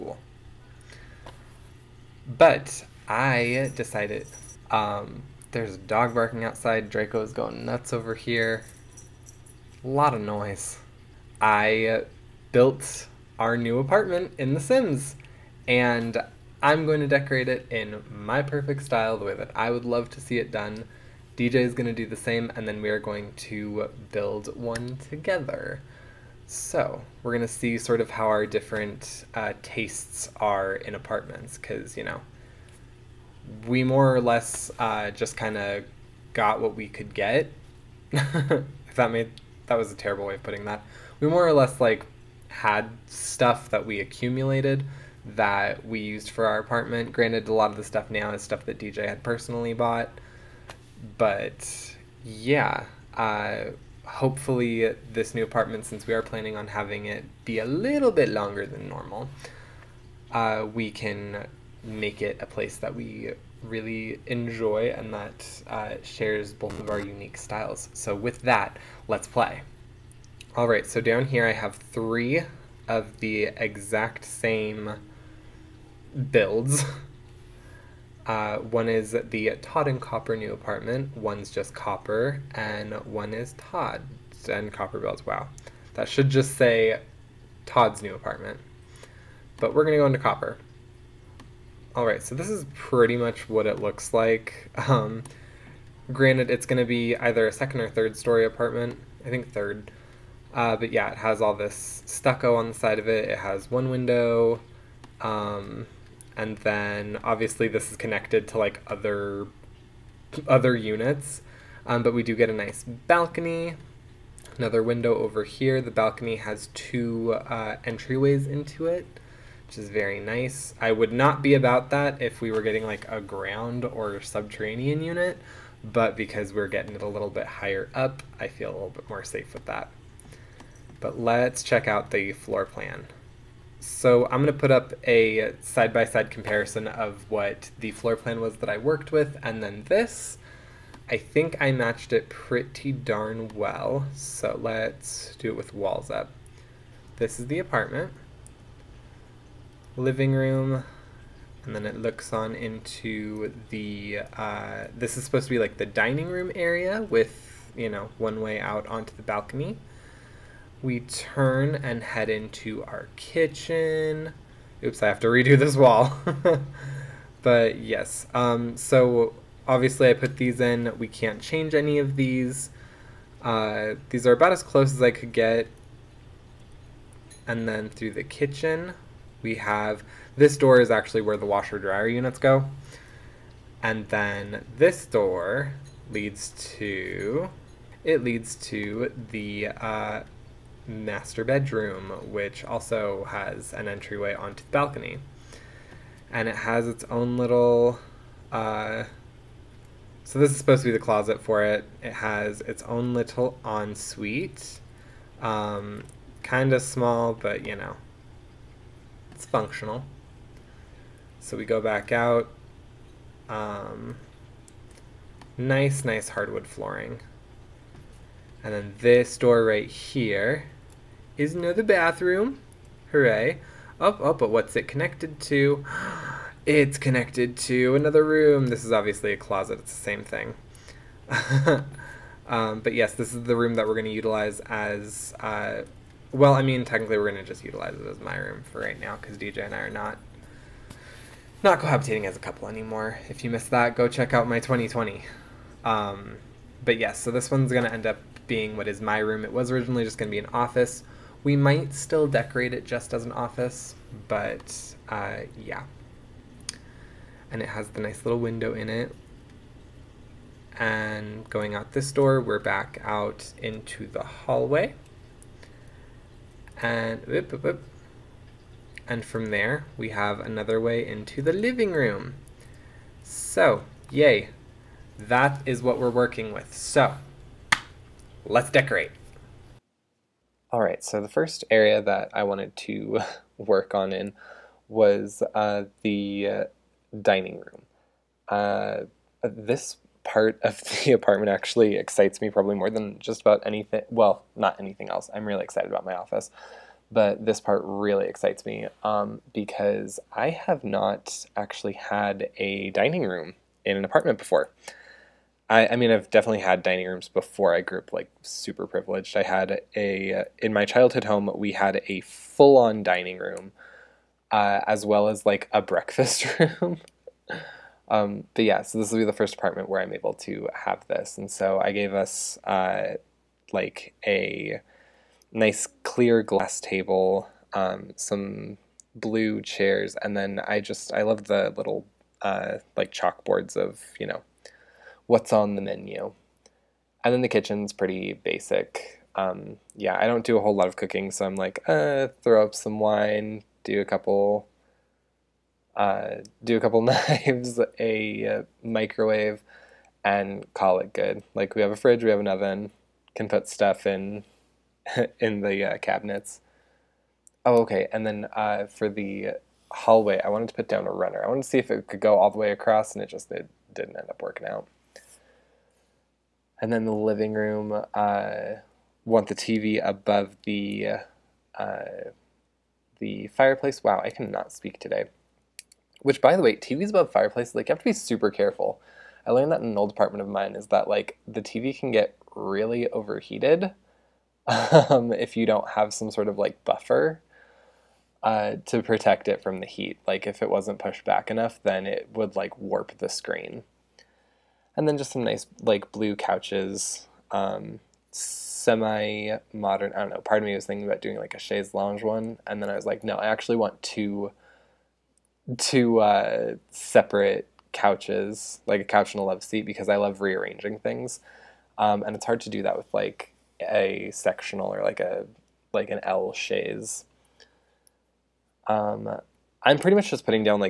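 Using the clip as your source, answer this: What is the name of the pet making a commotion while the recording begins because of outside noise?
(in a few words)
Draco.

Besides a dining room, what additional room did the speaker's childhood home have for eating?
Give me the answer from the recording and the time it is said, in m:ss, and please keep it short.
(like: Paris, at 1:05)
Breakfast room, at 5:15.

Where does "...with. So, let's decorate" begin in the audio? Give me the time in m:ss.
4:36.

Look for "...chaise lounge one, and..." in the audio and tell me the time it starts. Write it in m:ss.
6:41.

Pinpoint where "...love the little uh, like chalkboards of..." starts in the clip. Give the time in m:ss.
5:31.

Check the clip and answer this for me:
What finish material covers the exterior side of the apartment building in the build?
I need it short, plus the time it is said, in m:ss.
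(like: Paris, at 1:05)
Stucco, at 1:42.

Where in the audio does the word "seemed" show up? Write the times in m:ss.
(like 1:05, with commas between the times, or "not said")
not said.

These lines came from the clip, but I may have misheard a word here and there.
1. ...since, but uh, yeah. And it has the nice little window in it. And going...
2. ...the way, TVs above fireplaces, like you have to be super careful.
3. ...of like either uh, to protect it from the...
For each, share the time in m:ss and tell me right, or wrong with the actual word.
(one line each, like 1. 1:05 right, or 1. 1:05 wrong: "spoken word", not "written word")
1. 4:13 wrong: "office", not "since"
2. 6:16 right
3. 6:26 wrong: "buffer", not "either".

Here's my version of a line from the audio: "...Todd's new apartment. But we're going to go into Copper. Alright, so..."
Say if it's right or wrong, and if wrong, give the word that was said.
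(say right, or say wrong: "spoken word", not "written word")
right.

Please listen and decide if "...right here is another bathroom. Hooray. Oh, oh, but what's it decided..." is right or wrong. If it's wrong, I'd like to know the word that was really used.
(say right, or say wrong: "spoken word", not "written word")
wrong: "connected", not "decided".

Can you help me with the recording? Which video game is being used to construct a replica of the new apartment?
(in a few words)
The Sims.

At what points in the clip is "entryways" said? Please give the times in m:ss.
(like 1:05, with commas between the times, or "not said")
1:57, 3:13.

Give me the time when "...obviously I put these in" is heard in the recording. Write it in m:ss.
2:49.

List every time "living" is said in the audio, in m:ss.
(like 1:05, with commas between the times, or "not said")
2:29, 4:31, 6:07.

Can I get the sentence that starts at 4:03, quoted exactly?
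If you missed that, go check out my 2020.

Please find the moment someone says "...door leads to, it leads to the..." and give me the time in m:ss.
3:05.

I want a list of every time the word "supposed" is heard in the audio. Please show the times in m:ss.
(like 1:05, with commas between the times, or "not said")
2:35, 3:20.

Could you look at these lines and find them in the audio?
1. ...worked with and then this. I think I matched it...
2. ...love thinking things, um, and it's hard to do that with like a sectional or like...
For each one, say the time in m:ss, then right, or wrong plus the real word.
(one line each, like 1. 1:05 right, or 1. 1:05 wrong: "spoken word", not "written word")
1. 2:18 right
2. 6:50 wrong: "rearranging", not "thinking".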